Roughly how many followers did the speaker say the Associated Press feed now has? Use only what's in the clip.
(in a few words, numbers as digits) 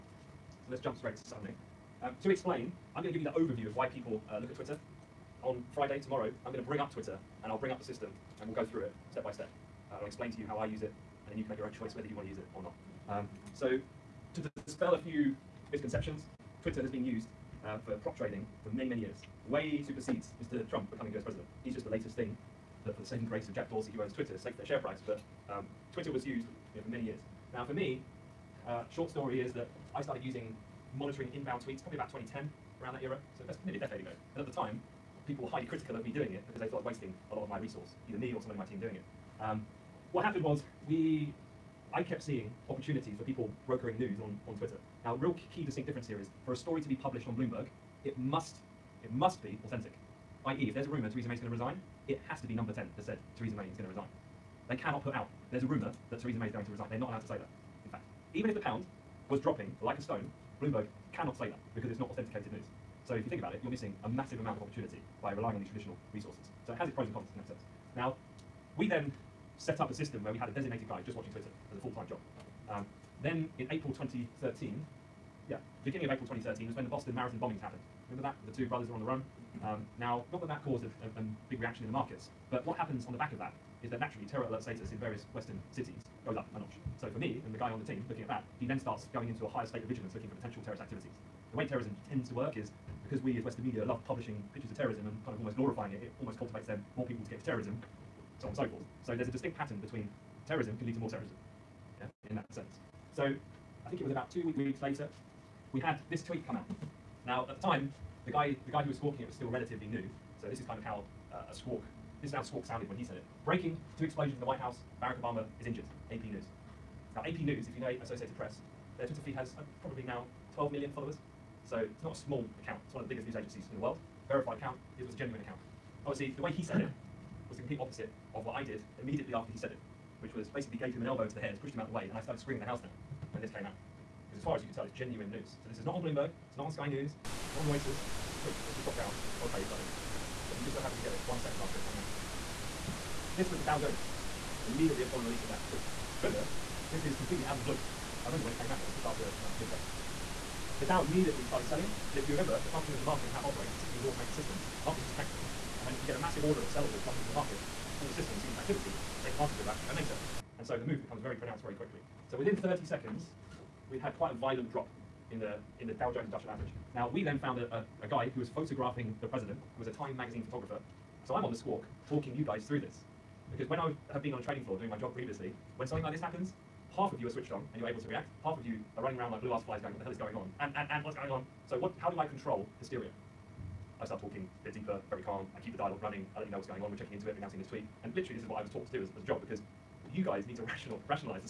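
12 million.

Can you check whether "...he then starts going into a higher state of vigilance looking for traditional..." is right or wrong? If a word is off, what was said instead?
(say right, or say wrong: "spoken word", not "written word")
wrong: "potential", not "traditional".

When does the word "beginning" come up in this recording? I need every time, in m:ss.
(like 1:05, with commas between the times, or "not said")
1:15.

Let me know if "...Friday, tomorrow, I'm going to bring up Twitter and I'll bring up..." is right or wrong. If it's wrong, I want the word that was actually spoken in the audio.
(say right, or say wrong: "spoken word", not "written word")
right.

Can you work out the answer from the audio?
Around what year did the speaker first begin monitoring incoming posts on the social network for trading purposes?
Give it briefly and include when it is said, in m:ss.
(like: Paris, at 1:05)
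2010, at 0:32.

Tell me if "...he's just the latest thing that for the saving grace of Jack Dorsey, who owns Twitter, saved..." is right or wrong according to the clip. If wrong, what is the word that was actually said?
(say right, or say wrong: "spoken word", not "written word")
right.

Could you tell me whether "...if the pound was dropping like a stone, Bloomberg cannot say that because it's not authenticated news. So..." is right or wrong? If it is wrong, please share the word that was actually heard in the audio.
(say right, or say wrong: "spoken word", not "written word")
right.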